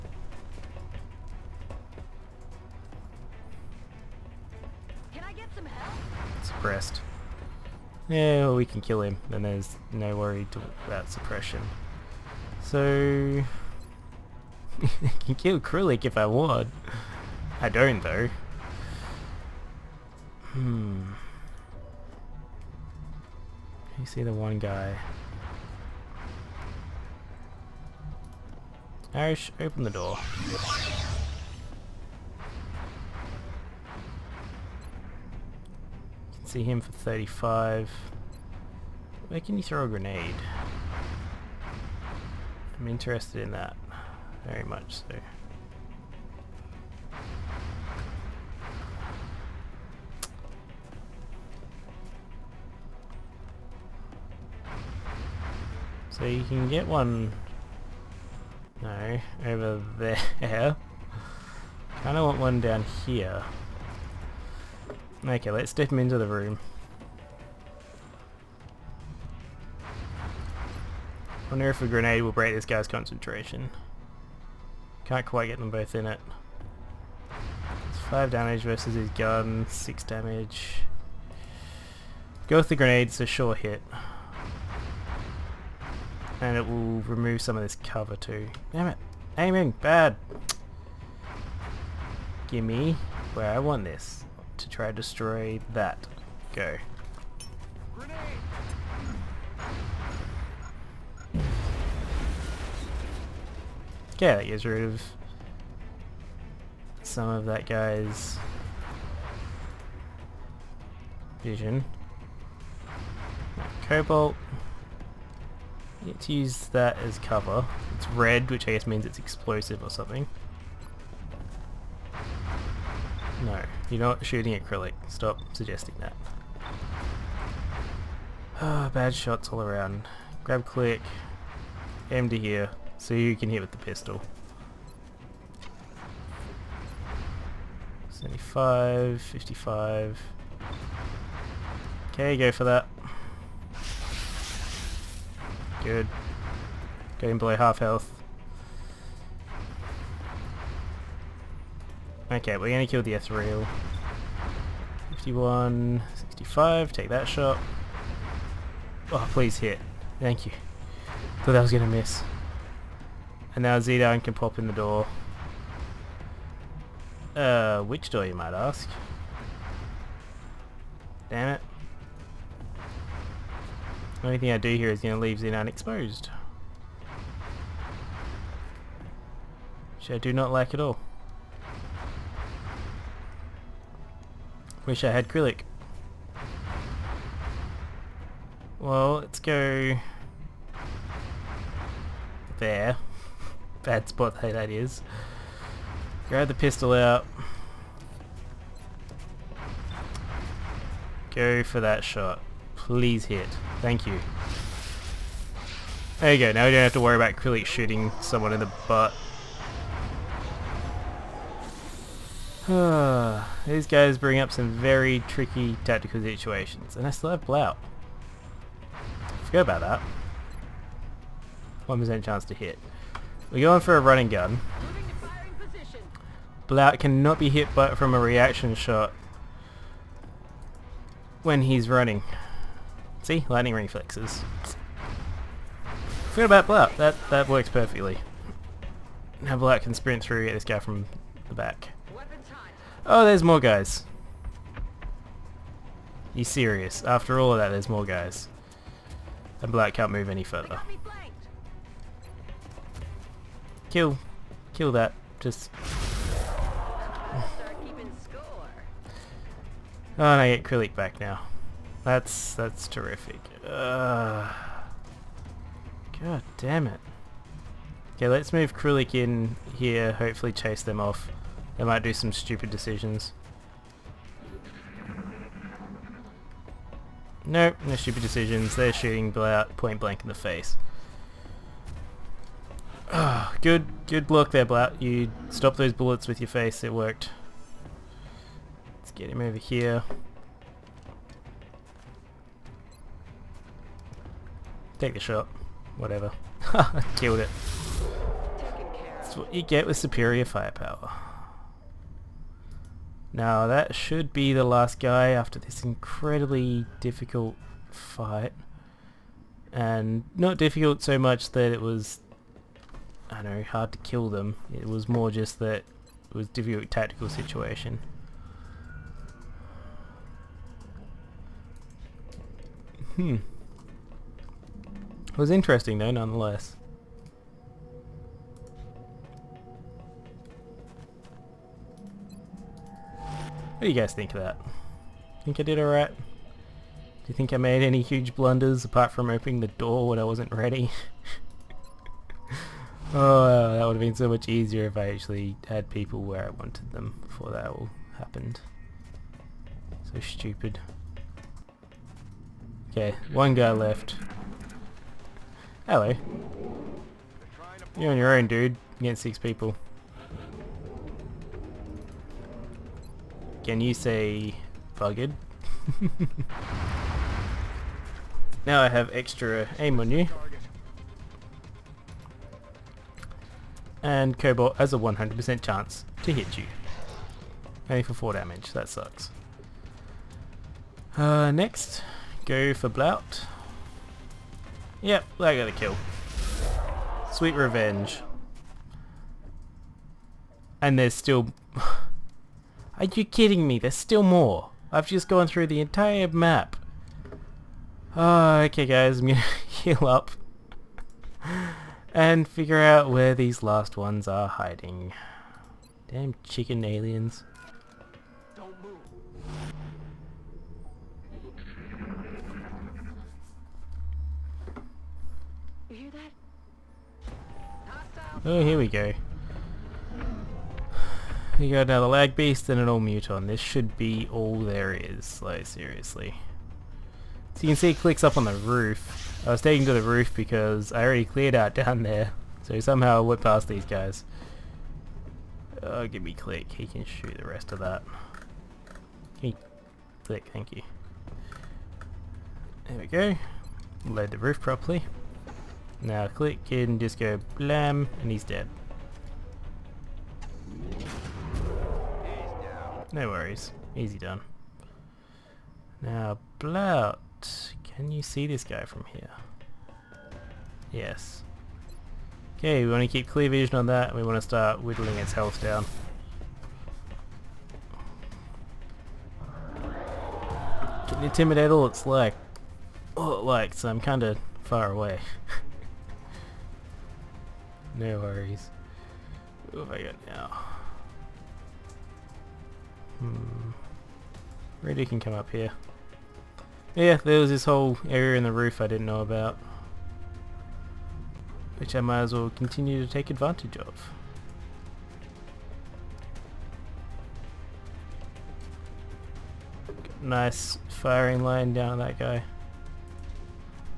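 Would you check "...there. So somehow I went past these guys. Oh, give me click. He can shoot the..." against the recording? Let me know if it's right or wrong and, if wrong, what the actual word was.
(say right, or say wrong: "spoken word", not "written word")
right.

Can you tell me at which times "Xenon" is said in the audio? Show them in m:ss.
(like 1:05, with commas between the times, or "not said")
2:43, 2:55.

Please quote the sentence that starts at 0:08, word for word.
Yeah, well, we can kill him, and there's no worry about suppression.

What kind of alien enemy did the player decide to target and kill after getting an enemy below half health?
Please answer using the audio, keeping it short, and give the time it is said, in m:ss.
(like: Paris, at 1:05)
Ethereal, at 2:33.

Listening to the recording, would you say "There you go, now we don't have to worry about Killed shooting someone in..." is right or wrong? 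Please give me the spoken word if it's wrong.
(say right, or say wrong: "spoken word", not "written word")
wrong: "Krillic", not "Killed".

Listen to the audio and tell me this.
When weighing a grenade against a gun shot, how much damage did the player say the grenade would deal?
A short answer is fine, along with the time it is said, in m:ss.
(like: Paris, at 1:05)
5, at 1:18.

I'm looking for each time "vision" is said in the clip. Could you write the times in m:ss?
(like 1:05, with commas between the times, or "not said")
1:51, 7:43.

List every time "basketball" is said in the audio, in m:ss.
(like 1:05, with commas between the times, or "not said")
not said.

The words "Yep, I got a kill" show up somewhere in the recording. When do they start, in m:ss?
6:25.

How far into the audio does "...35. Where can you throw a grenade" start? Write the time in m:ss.
0:36.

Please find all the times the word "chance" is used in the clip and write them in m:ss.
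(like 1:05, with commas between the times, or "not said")
3:42, 6:15.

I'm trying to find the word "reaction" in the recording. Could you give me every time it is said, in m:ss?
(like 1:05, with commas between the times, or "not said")
3:48.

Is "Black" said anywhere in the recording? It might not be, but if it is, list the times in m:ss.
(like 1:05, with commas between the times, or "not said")
4:09.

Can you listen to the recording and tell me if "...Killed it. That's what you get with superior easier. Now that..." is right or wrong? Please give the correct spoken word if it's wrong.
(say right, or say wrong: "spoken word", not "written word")
wrong: "firepower", not "easier".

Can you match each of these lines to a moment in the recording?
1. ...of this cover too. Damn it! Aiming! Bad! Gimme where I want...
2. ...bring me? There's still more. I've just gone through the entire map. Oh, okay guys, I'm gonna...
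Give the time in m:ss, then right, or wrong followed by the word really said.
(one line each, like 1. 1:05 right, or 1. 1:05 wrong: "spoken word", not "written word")
1. 1:27 right
2. 6:33 wrong: "kidding", not "bring".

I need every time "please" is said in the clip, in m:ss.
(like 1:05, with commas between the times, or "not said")
2:39, 3:22.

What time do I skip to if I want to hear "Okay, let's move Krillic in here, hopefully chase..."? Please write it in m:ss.
4:28.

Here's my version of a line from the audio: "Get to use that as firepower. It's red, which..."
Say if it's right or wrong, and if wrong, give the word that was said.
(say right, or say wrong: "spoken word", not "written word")
wrong: "cover", not "firepower".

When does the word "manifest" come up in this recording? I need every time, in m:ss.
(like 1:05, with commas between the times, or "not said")
not said.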